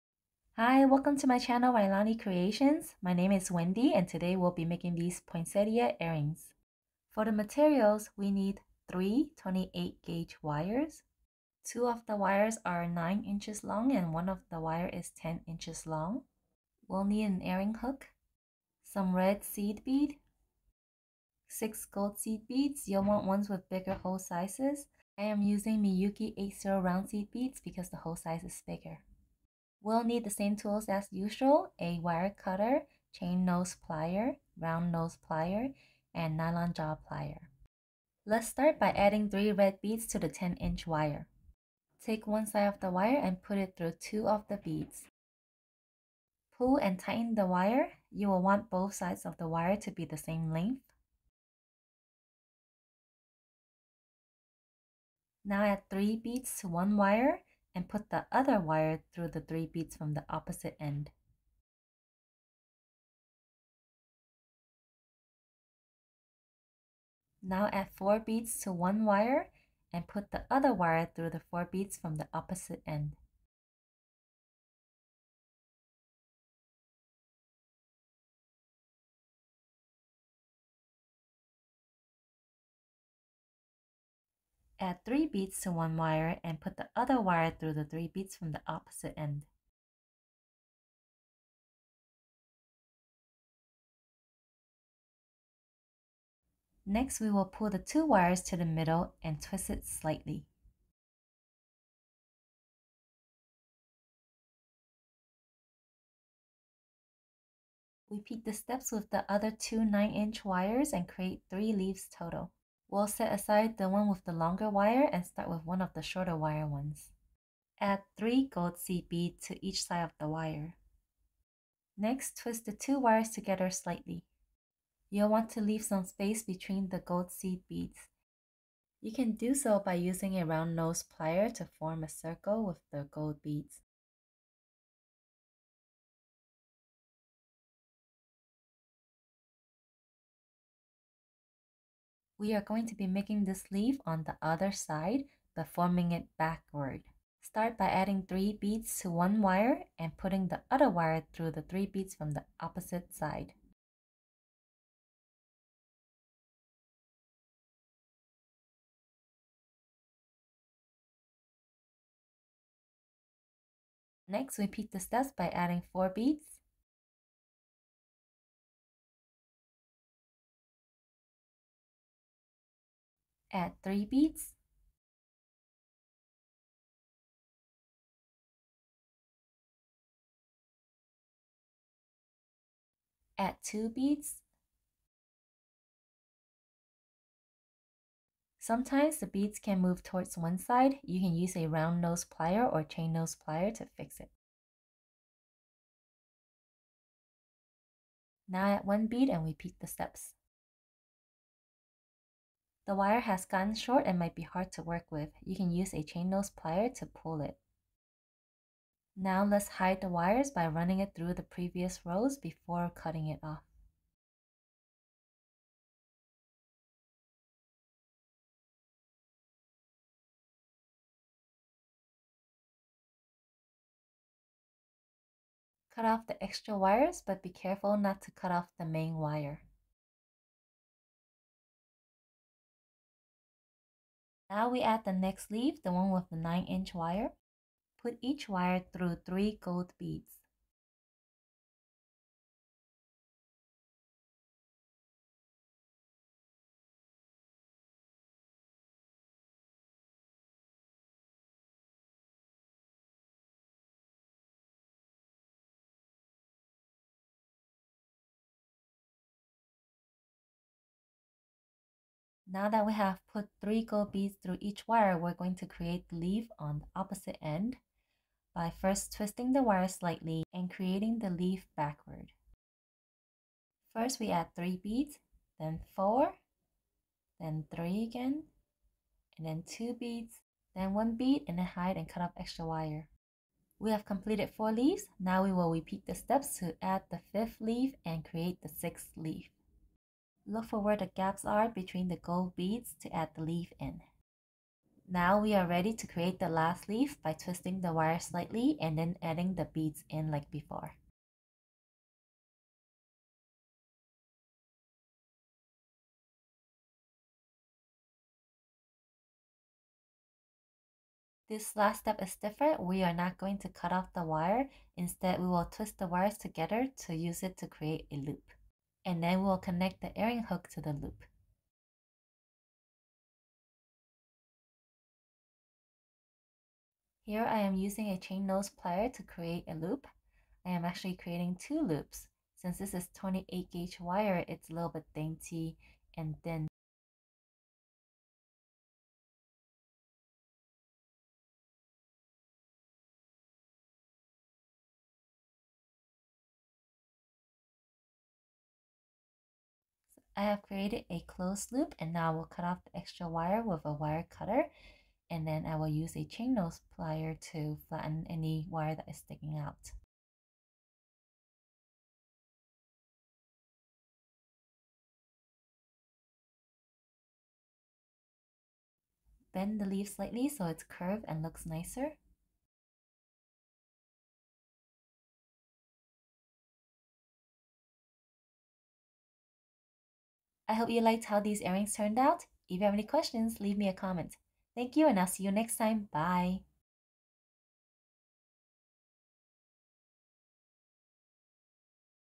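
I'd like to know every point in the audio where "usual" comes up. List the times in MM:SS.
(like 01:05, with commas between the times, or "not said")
00:31.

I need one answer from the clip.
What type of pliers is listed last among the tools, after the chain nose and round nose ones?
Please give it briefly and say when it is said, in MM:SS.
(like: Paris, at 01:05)
nylon jaw plier, at 00:36.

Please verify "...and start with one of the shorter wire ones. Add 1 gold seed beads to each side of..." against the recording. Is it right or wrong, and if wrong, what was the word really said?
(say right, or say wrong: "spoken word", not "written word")
wrong: "3", not "1".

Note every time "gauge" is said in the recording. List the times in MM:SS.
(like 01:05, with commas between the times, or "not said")
00:10, 05:33.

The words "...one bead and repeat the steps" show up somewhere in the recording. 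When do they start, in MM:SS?
03:18.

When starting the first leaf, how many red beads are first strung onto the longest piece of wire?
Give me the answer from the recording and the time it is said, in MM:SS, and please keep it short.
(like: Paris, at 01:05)
3, at 00:39.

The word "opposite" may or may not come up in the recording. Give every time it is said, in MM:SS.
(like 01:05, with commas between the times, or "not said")
01:00, 01:12, 01:28, 02:32, 04:26.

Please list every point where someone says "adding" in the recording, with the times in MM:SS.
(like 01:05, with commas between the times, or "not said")
00:38, 02:27, 02:45, 04:59.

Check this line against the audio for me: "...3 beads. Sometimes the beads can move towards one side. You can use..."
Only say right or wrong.
wrong.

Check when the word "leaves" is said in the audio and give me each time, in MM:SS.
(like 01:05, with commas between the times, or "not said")
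01:51, 02:05, 04:44, 06:23.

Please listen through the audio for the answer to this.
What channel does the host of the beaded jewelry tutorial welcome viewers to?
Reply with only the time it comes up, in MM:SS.
00:01.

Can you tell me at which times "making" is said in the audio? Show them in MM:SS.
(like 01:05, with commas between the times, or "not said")
00:04, 02:23.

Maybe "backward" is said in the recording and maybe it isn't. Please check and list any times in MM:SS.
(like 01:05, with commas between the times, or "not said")
02:26, 04:31.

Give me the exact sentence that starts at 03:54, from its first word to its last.
Now we add the next leaf, the one with the 9 inch wire.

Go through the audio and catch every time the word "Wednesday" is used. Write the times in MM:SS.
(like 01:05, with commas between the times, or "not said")
not said.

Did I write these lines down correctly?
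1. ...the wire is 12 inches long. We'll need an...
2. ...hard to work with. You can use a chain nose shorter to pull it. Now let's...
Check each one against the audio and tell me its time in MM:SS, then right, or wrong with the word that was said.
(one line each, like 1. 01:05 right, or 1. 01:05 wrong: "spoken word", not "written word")
1. 00:14 wrong: "10", not "12"
2. 03:24 wrong: "plier", not "shorter".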